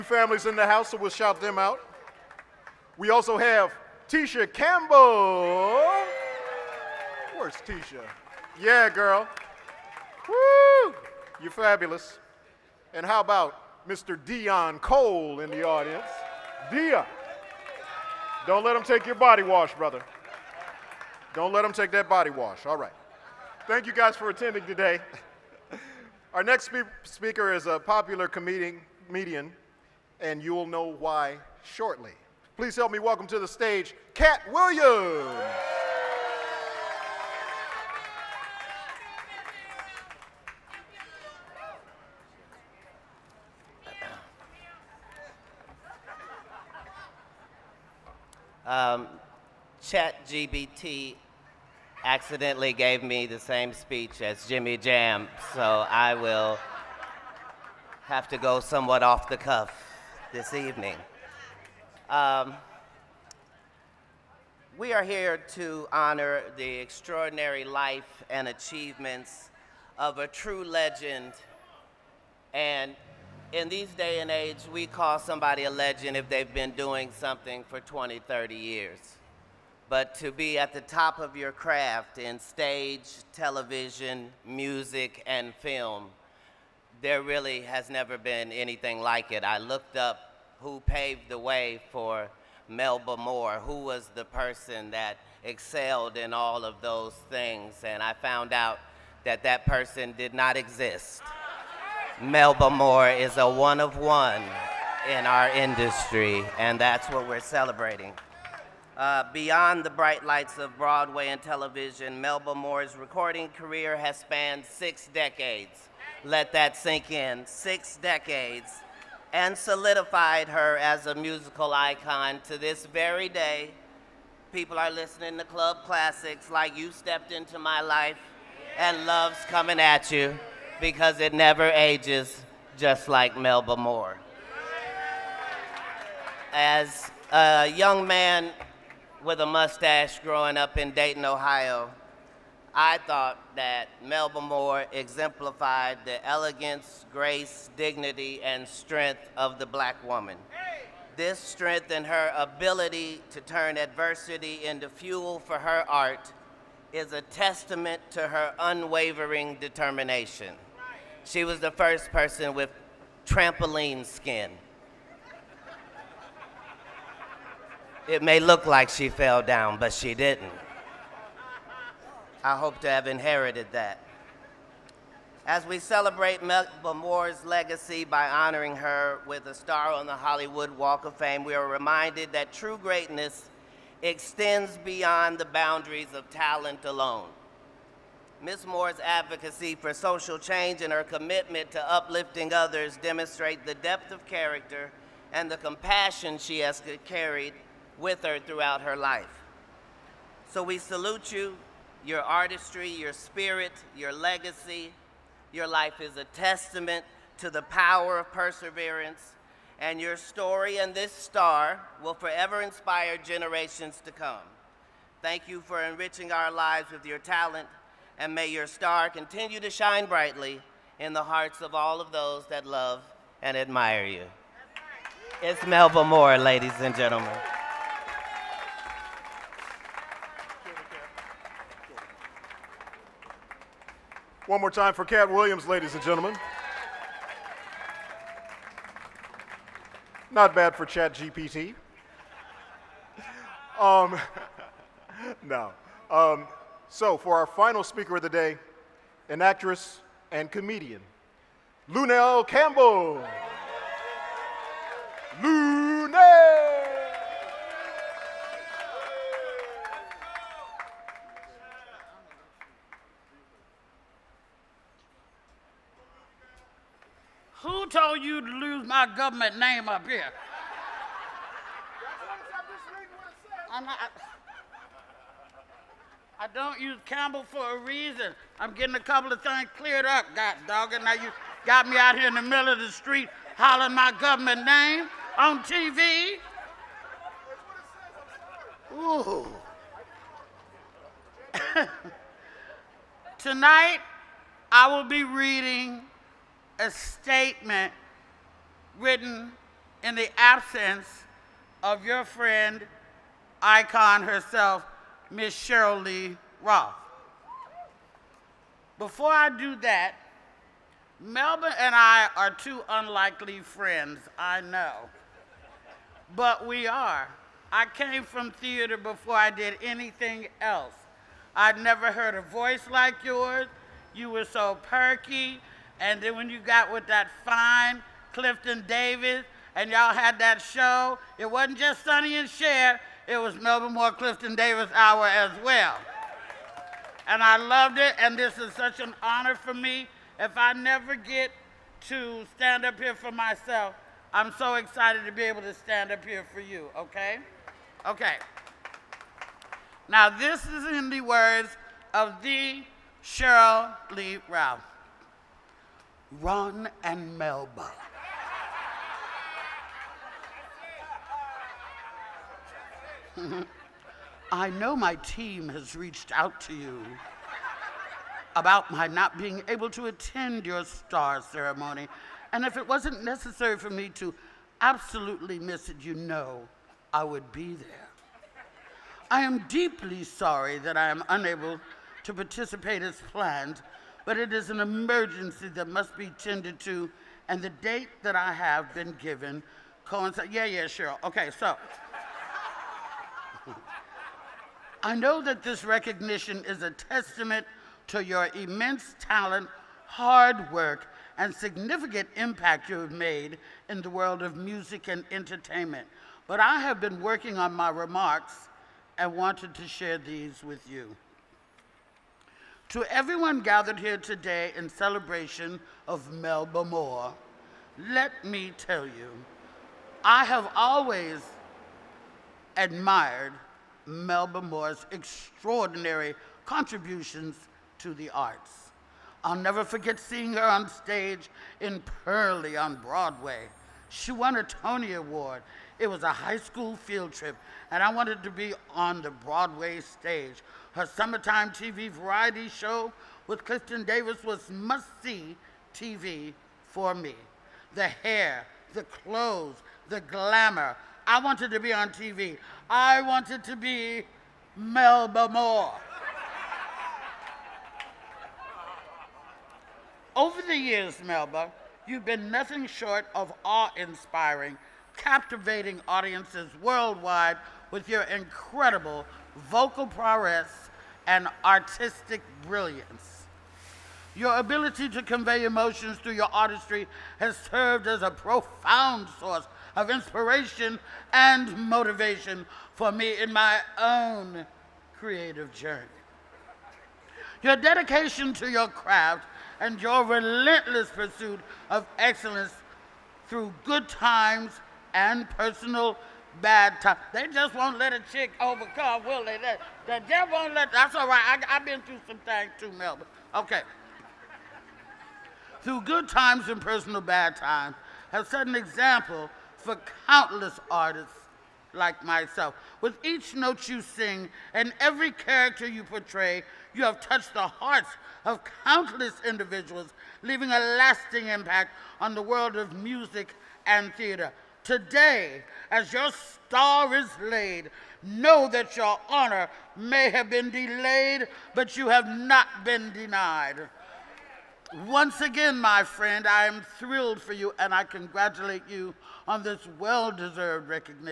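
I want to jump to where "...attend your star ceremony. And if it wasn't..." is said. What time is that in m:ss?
6:10.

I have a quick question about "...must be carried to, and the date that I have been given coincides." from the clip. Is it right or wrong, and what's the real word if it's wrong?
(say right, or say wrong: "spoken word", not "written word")
wrong: "tended", not "carried".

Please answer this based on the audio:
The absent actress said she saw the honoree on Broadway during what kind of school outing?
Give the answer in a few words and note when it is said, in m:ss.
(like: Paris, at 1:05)
a high school field trip, at 7:16.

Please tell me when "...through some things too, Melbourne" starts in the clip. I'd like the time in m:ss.
8:22.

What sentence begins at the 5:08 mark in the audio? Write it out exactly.
Before I do that, Melbourne and I are two unlikely friends, I know.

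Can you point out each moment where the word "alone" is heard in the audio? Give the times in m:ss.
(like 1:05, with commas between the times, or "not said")
3:06.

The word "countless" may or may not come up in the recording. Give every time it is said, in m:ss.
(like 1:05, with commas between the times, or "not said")
8:30, 8:38.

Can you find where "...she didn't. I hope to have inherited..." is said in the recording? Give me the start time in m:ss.
2:49.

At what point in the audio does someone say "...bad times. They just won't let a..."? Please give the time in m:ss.
8:16.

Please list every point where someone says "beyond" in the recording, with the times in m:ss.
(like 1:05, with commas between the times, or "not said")
1:49, 3:04.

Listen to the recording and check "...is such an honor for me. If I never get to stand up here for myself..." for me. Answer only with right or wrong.
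right.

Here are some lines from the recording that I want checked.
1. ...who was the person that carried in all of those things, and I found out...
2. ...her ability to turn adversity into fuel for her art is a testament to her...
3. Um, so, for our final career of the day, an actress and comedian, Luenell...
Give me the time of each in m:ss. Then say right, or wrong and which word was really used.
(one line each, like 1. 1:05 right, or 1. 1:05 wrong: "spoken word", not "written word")
1. 1:33 wrong: "excelled", not "carried"
2. 2:32 right
3. 4:06 wrong: "speaker", not "career".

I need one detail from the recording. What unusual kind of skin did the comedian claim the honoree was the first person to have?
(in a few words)
trampoline skin.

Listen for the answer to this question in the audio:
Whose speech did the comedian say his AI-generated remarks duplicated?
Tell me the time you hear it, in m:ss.
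0:54.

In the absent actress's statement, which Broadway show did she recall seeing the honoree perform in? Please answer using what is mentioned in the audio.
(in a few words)
Purlie.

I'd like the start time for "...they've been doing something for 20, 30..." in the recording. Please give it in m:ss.
1:16.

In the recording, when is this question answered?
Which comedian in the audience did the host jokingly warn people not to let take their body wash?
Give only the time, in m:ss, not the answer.
0:14.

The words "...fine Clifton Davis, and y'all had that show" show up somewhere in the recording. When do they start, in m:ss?
5:27.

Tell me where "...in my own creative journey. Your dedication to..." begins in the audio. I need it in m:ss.
8:03.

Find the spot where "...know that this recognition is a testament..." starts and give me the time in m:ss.
6:35.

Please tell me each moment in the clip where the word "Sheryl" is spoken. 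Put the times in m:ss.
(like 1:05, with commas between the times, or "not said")
5:05, 5:53.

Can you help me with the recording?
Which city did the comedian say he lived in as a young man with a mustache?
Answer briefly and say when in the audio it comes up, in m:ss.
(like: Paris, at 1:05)
Dayton, Ohio, at 2:20.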